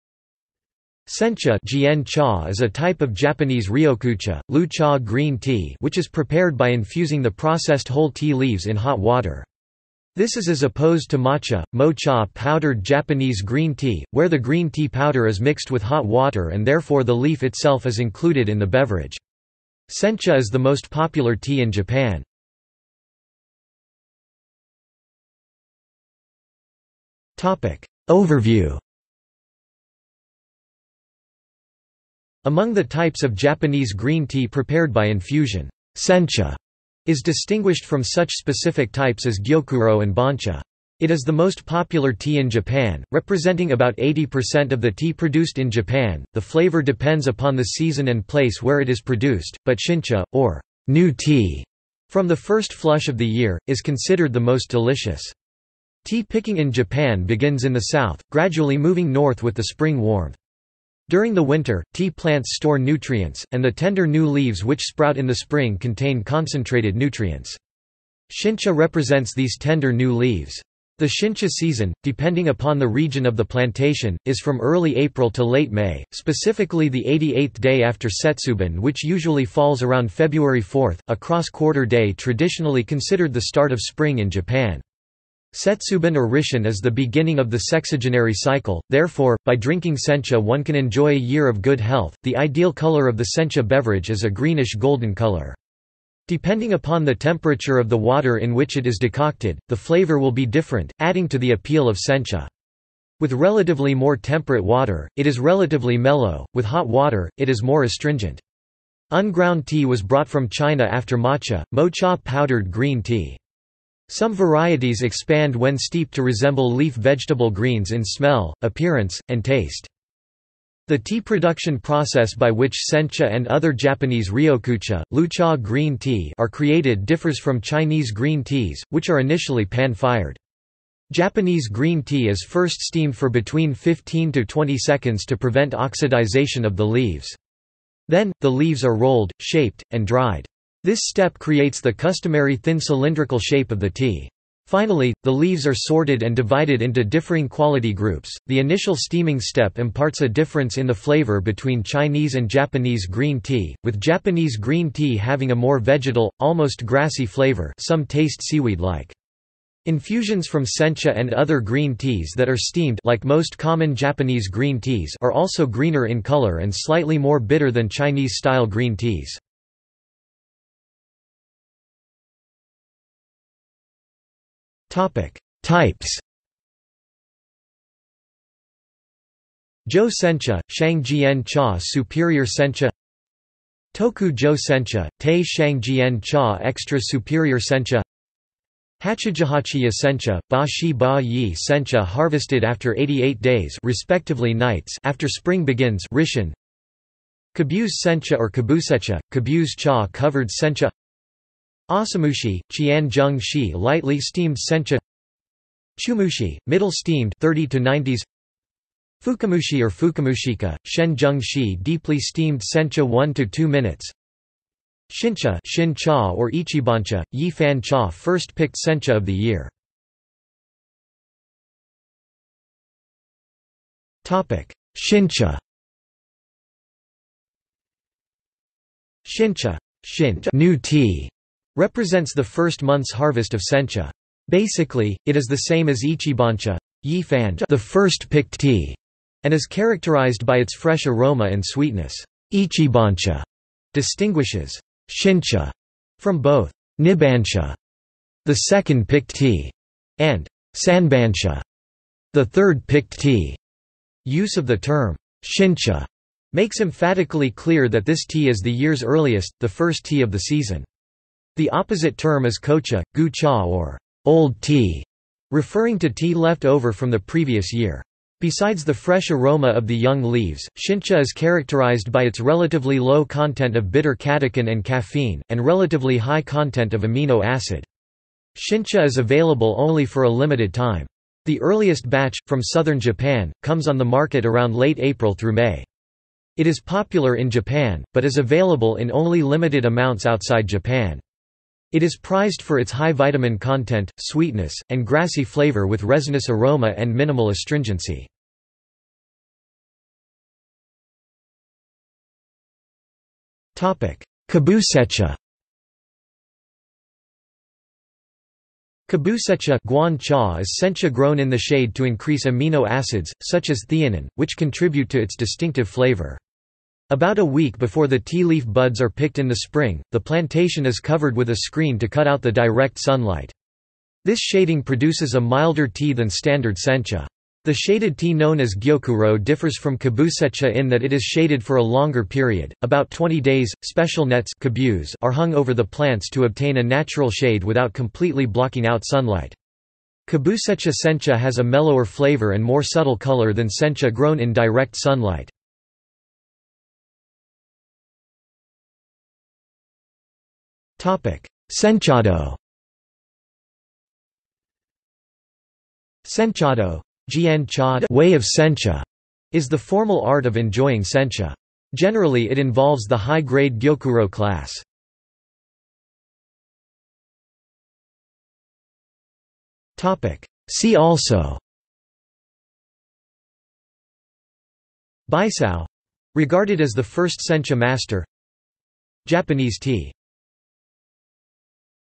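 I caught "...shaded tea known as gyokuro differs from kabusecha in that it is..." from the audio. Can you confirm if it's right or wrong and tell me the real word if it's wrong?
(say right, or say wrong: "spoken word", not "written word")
right.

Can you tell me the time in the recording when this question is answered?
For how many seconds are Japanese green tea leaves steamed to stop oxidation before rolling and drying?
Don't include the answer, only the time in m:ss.
2:13.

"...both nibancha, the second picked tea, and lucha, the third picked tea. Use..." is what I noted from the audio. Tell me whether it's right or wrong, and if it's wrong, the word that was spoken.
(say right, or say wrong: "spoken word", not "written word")
wrong: "sanbancha", not "lucha".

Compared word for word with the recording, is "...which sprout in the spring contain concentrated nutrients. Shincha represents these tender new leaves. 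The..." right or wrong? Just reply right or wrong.
right.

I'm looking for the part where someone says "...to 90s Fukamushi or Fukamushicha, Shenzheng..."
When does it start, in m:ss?
3:27.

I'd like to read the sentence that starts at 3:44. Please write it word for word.
Shincha Shincha, Shincha new tea, represents the first month's harvest of sencha.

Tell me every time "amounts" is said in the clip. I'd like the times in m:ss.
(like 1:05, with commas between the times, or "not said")
4:49.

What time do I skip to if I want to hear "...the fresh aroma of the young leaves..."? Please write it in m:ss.
4:28.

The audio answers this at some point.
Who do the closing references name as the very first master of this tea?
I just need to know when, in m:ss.
6:15.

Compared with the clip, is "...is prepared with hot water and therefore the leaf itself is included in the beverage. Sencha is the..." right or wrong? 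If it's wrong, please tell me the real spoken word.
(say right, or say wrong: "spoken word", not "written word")
wrong: "mixed", not "prepared".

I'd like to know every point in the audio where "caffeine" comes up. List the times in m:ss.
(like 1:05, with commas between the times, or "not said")
4:34.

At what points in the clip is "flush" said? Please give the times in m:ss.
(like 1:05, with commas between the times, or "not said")
0:52.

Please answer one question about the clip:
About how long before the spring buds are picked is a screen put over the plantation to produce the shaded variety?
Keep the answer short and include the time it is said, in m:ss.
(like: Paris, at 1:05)
About a week, at 5:17.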